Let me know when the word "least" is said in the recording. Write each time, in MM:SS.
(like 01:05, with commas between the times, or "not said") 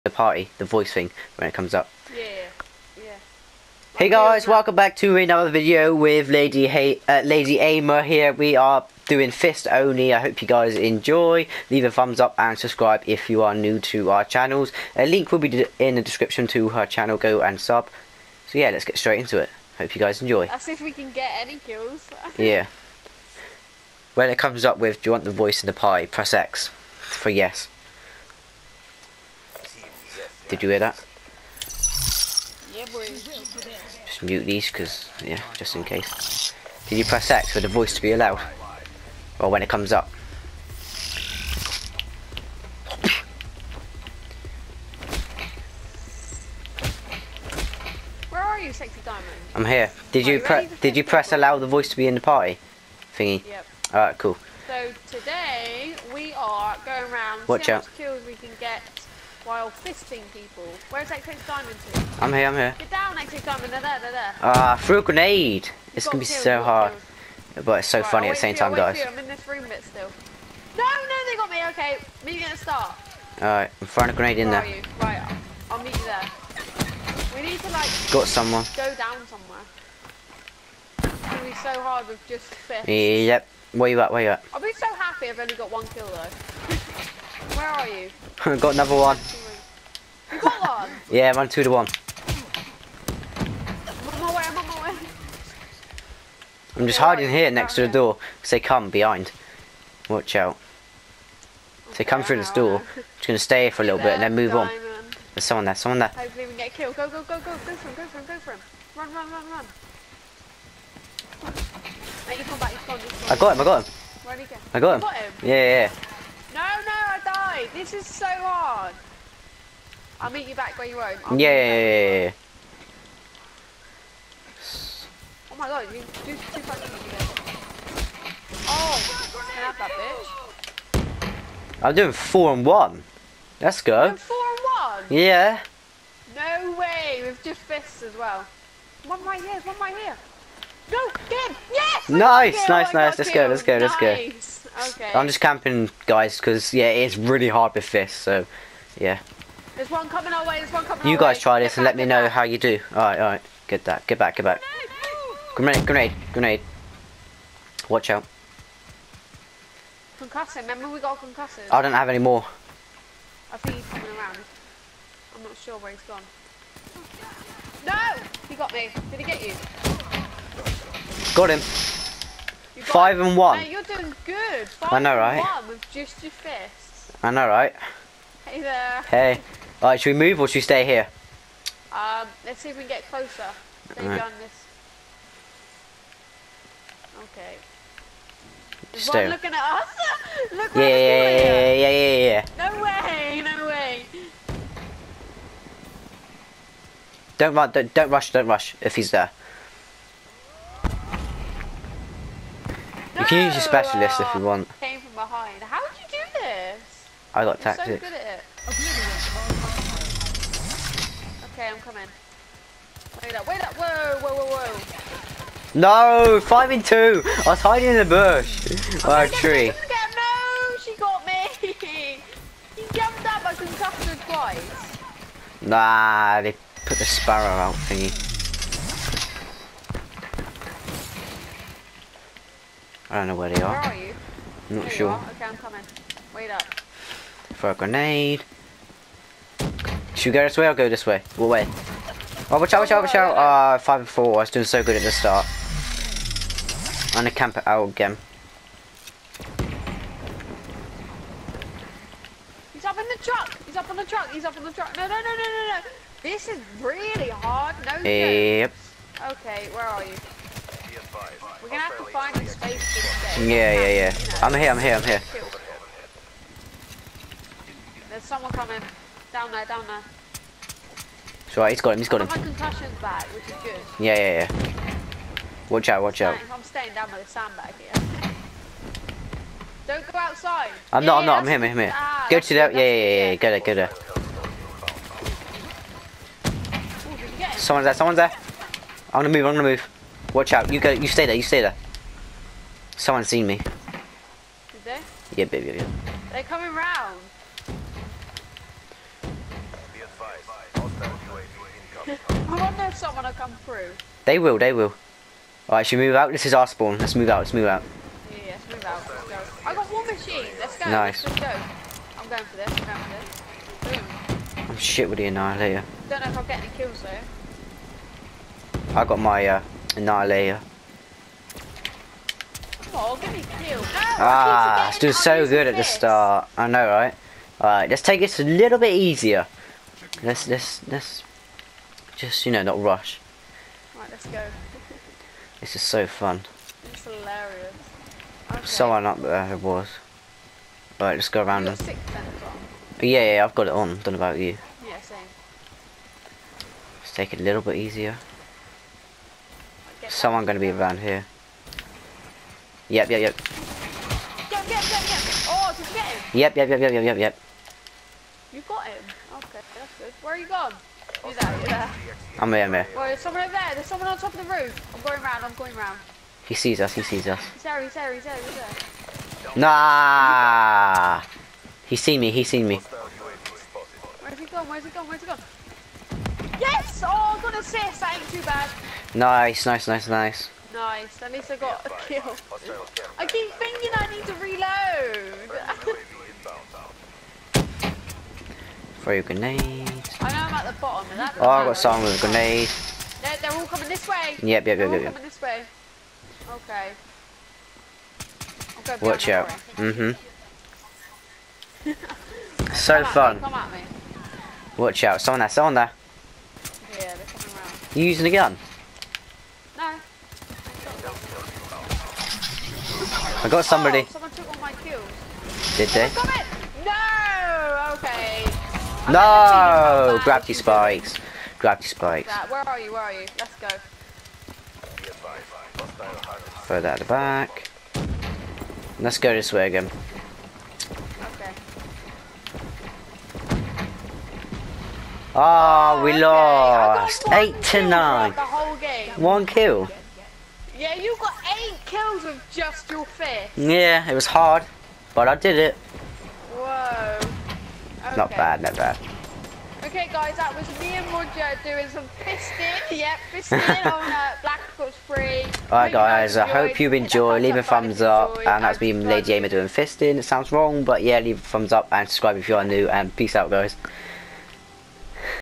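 06:21.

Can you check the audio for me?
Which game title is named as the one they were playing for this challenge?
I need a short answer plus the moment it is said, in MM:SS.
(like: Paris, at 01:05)
Black Ops 3, at 07:34.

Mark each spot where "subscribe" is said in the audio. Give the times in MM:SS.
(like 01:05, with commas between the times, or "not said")
00:12, 07:42.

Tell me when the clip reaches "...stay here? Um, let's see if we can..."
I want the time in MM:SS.
03:00.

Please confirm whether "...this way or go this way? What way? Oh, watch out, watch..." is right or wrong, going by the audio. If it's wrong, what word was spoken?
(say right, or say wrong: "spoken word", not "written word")
right.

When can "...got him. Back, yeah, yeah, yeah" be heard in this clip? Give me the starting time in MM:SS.
04:32.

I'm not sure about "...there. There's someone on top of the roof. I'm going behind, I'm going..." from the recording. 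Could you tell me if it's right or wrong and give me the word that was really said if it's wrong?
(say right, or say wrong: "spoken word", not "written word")
wrong: "round", not "behind".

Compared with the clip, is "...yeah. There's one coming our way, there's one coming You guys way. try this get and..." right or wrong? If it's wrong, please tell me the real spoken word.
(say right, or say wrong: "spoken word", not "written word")
right.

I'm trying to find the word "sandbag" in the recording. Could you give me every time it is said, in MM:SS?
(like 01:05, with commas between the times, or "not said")
04:37.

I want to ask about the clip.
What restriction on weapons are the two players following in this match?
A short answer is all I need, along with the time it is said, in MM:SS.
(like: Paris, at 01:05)
Fist only, at 00:09.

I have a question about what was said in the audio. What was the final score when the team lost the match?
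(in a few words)
8 to 9.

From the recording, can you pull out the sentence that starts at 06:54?
Oh, someone took all my kills.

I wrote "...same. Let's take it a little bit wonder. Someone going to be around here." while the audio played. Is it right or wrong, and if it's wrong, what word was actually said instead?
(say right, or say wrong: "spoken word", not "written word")
wrong: "easier", not "wonder".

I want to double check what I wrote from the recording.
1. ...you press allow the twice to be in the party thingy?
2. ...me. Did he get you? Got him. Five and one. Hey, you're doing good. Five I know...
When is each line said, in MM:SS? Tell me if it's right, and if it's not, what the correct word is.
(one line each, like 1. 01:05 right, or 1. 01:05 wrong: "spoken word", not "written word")
1. 00:50 wrong: "voice", not "twice"
2. 02:48 right.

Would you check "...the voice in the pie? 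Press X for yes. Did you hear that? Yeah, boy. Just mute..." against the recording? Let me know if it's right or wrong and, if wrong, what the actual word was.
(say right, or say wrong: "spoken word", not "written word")
right.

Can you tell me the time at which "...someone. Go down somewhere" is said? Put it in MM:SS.
01:18.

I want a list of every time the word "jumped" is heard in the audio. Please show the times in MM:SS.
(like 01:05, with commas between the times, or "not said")
03:42.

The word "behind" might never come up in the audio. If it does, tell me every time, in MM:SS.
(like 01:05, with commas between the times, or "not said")
01:38, 03:25.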